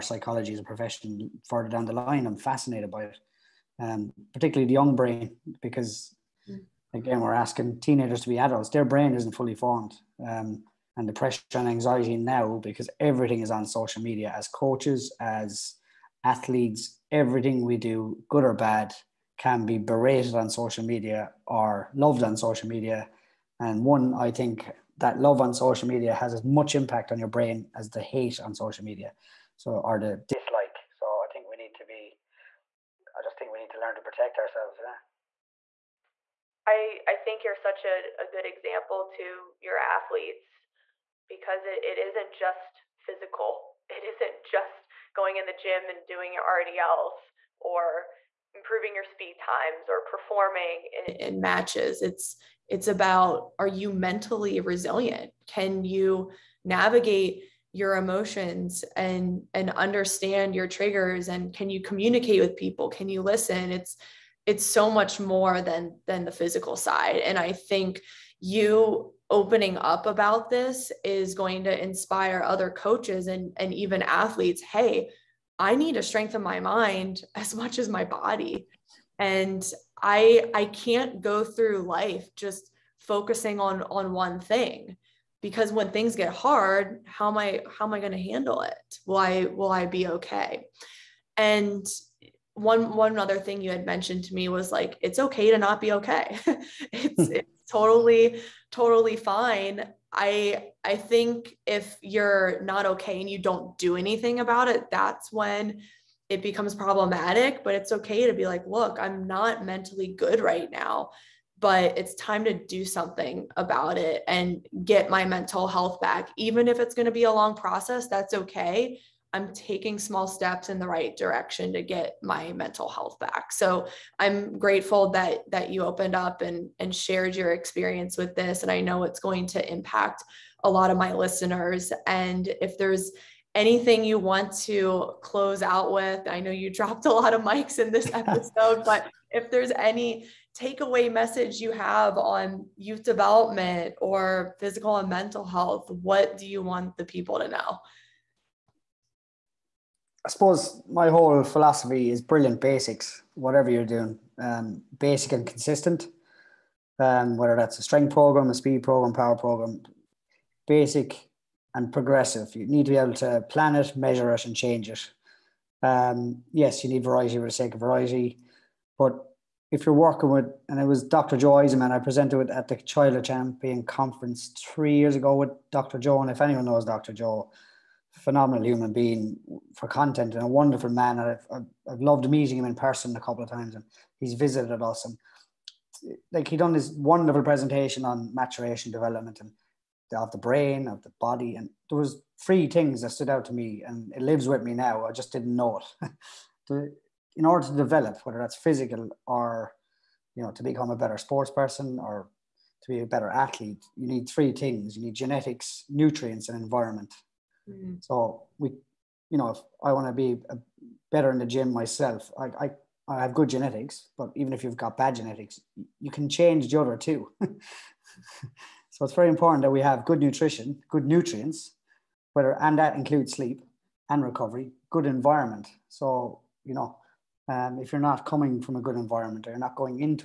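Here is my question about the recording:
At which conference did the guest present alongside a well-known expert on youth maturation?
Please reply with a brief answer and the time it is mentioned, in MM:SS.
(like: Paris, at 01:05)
Child Champion Conference, at 02:52.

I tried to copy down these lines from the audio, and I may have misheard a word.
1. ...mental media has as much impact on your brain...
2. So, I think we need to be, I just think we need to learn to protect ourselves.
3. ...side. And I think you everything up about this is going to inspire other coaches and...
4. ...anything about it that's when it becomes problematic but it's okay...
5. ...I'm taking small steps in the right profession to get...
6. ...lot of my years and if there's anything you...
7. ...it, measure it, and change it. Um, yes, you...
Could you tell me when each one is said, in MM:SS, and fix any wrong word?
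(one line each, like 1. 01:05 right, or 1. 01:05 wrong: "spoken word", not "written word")
1. 00:25 wrong: "social", not "mental"
2. 00:30 right
3. 01:06 wrong: "opening", not "everything"
4. 01:43 right
5. 01:59 wrong: "direction", not "profession"
6. 02:10 wrong: "listeners", not "years"
7. 02:43 right.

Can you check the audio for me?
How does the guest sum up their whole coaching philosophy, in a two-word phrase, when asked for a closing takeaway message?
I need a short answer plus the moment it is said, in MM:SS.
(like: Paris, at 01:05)
Brilliant basics, at 02:32.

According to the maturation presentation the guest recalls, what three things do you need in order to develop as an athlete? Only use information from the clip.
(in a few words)
Genetics, nutrients, and environment.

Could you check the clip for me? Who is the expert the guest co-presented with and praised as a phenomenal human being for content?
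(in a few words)
Dr. Joe Eisenmann.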